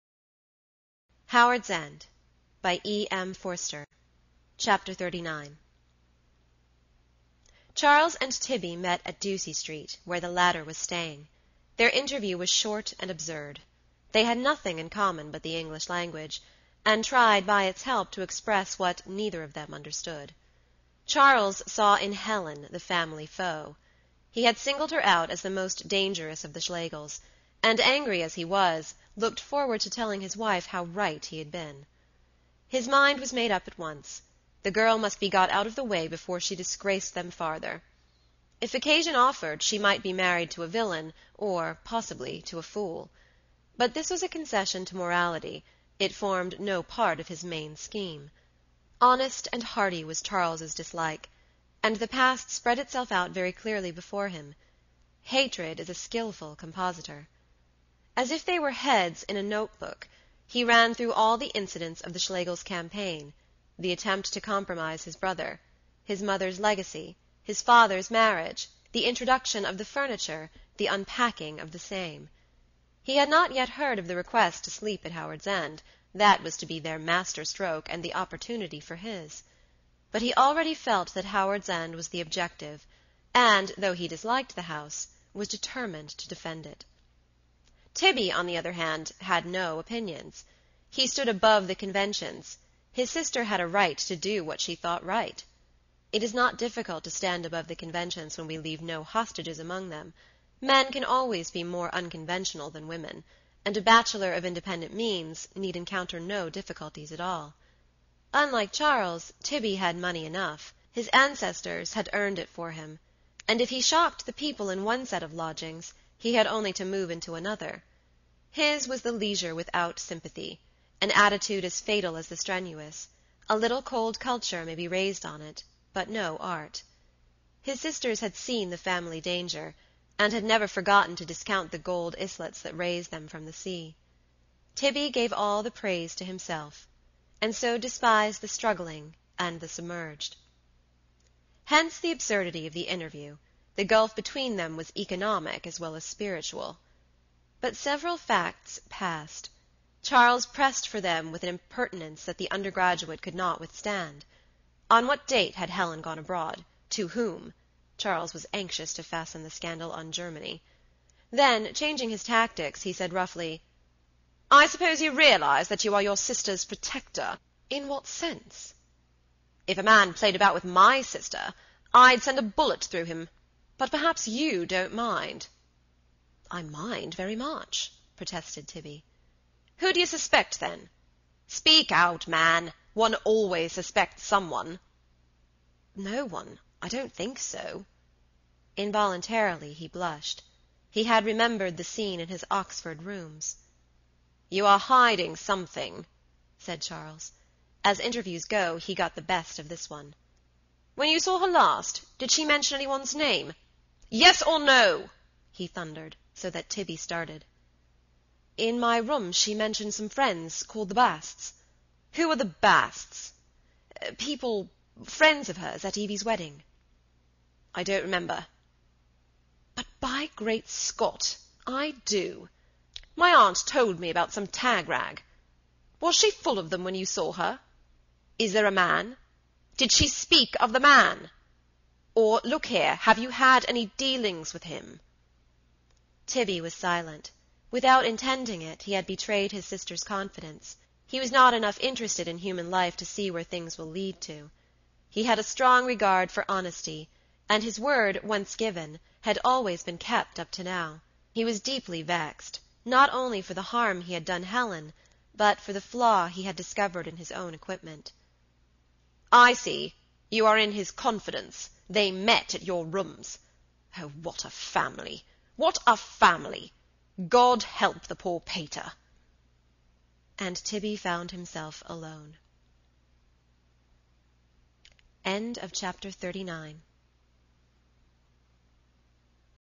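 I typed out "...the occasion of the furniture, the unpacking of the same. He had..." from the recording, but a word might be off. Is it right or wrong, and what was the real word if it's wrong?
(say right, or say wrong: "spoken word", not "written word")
wrong: "introduction", not "occasion".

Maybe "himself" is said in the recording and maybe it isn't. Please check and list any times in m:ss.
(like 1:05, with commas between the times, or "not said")
2:16, 4:31.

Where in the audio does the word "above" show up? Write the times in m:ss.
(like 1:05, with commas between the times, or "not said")
1:31, 1:37.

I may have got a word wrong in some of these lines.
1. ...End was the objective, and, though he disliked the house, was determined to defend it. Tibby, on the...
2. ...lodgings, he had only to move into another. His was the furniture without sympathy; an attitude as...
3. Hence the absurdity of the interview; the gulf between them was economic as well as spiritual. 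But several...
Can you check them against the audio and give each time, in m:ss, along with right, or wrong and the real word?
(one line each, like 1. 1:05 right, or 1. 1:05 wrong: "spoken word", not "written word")
1. 1:21 right
2. 1:55 wrong: "leisure", not "furniture"
3. 2:21 right.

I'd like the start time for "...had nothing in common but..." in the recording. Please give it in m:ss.
0:14.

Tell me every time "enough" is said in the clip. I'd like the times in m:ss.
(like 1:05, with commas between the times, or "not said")
1:50, 4:01.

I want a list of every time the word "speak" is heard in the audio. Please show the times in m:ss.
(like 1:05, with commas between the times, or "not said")
3:01, 3:50.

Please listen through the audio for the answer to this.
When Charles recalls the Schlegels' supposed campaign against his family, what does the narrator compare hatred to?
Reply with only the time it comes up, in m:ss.
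0:55.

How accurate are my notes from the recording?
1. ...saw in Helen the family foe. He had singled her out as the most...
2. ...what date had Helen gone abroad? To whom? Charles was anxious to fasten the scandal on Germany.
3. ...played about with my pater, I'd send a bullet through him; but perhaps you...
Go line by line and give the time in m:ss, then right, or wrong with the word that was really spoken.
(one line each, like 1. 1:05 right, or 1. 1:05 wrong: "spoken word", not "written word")
1. 0:21 right
2. 2:35 right
3. 2:50 wrong: "sister", not "pater".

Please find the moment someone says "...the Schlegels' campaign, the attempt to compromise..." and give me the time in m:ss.
1:02.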